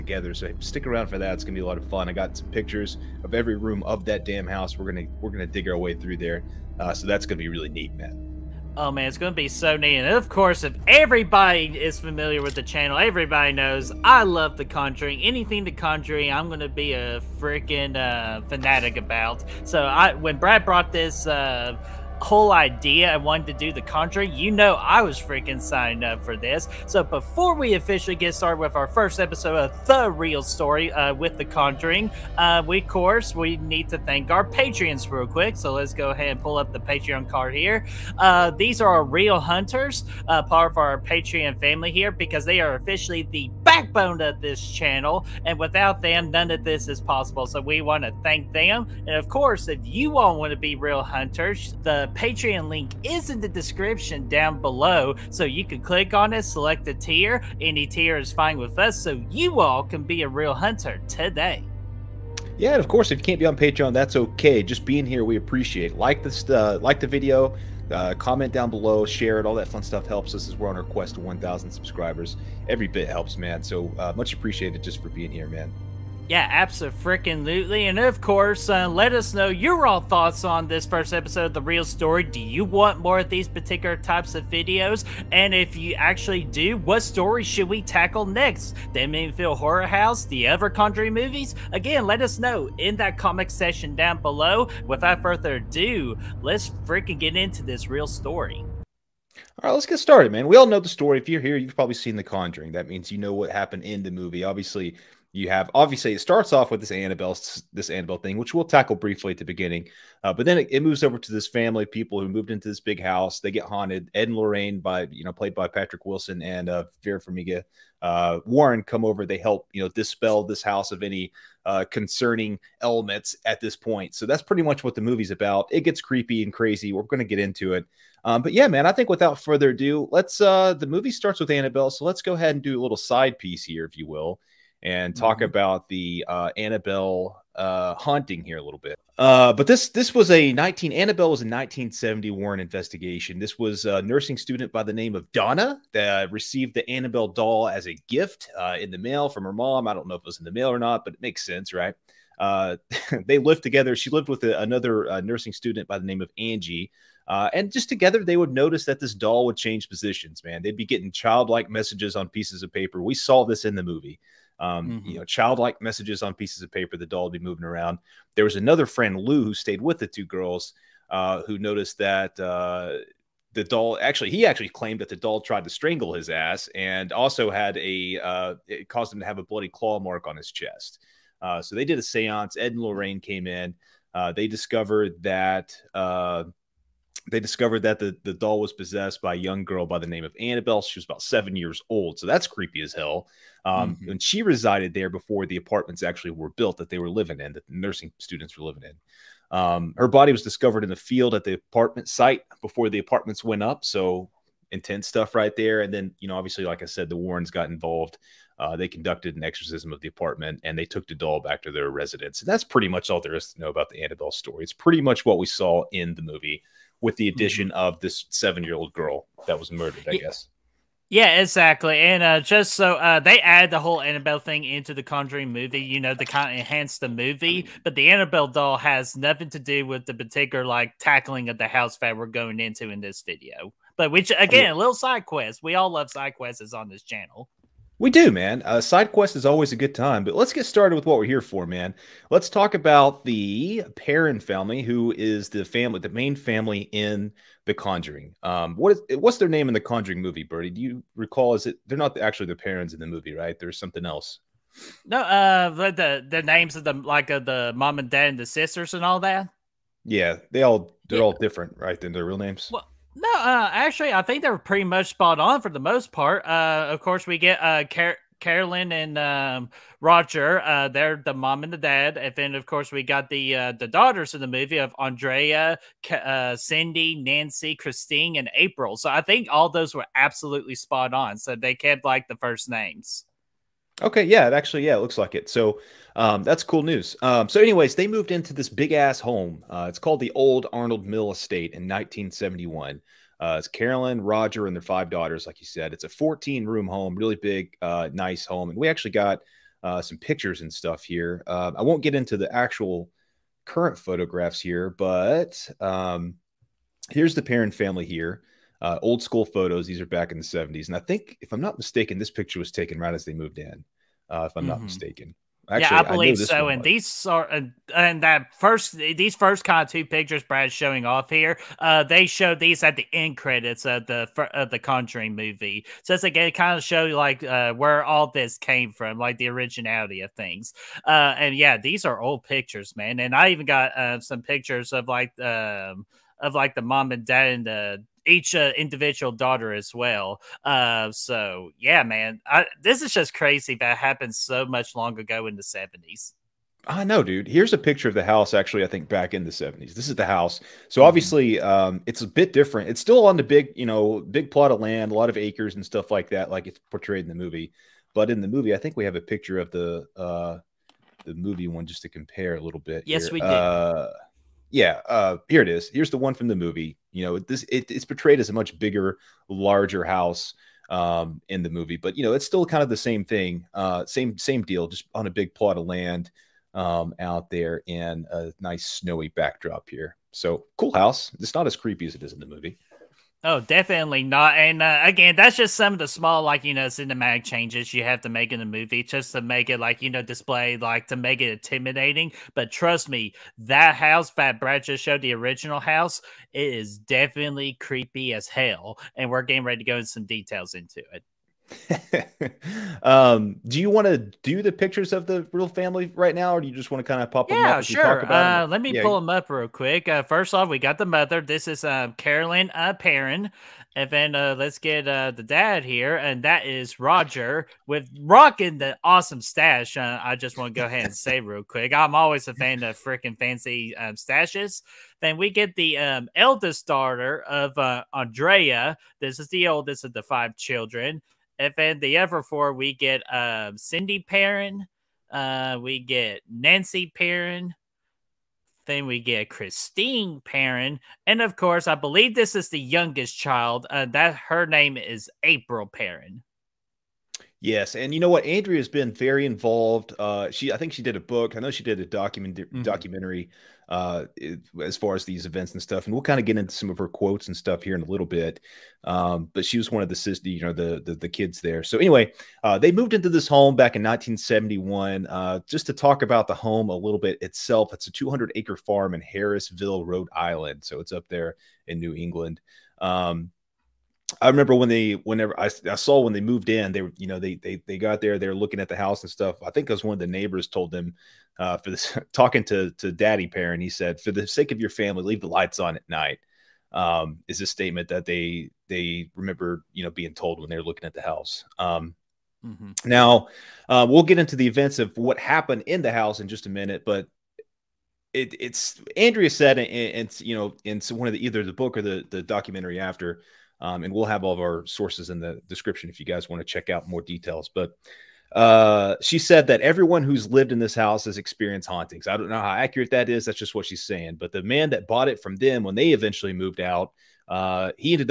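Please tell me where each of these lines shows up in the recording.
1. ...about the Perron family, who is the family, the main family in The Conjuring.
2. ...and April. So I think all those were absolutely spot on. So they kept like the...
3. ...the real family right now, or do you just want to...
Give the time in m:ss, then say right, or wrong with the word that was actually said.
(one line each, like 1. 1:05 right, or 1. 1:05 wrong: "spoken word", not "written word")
1. 4:02 right
2. 4:38 right
3. 6:45 right.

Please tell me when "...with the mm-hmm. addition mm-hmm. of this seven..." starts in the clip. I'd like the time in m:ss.
3:37.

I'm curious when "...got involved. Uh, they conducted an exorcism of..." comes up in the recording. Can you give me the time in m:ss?
3:27.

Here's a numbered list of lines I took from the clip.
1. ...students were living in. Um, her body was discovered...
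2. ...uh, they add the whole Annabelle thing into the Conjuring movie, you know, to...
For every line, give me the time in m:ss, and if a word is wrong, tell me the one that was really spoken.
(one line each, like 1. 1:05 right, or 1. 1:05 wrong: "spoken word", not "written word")
1. 3:18 right
2. 3:42 right.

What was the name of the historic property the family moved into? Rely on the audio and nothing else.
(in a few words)
Old Arnold Mill Estate.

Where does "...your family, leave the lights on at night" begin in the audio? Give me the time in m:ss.
8:04.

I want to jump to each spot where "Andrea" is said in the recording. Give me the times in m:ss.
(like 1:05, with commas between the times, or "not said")
4:34, 7:08, 7:28, 8:19.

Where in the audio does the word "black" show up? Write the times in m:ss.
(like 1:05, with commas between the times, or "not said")
not said.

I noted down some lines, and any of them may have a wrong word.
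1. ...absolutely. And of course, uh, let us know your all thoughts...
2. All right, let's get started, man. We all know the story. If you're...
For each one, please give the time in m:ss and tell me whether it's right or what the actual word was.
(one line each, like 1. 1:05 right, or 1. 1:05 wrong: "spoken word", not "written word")
1. 1:16 right
2. 1:39 right.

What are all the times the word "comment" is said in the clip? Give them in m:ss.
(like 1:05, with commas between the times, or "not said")
1:08, 1:33.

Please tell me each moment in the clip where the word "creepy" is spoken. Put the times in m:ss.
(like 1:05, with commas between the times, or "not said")
2:06, 3:12, 6:21, 6:37.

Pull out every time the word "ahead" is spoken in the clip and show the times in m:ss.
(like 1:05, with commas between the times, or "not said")
0:36, 2:12, 7:00.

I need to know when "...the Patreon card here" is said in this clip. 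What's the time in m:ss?
0:36.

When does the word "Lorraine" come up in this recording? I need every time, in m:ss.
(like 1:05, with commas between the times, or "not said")
1:54, 3:02.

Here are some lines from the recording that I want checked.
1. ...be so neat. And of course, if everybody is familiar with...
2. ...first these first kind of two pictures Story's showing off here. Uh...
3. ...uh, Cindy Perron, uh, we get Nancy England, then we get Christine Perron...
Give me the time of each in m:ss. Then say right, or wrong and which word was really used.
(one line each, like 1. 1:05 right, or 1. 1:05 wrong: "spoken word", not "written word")
1. 0:09 right
2. 5:18 wrong: "Brad", not "Story"
3. 7:13 wrong: "Perron", not "England".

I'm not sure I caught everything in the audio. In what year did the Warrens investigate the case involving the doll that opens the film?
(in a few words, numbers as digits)
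1970.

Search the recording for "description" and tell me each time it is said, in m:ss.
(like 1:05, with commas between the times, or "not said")
0:53, 8:25.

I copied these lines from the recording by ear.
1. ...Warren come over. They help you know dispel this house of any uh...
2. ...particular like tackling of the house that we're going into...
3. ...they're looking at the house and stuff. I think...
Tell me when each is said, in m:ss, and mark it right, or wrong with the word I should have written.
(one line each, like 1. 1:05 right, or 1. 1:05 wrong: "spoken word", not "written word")
1. 1:58 right
2. 3:50 right
3. 7:58 right.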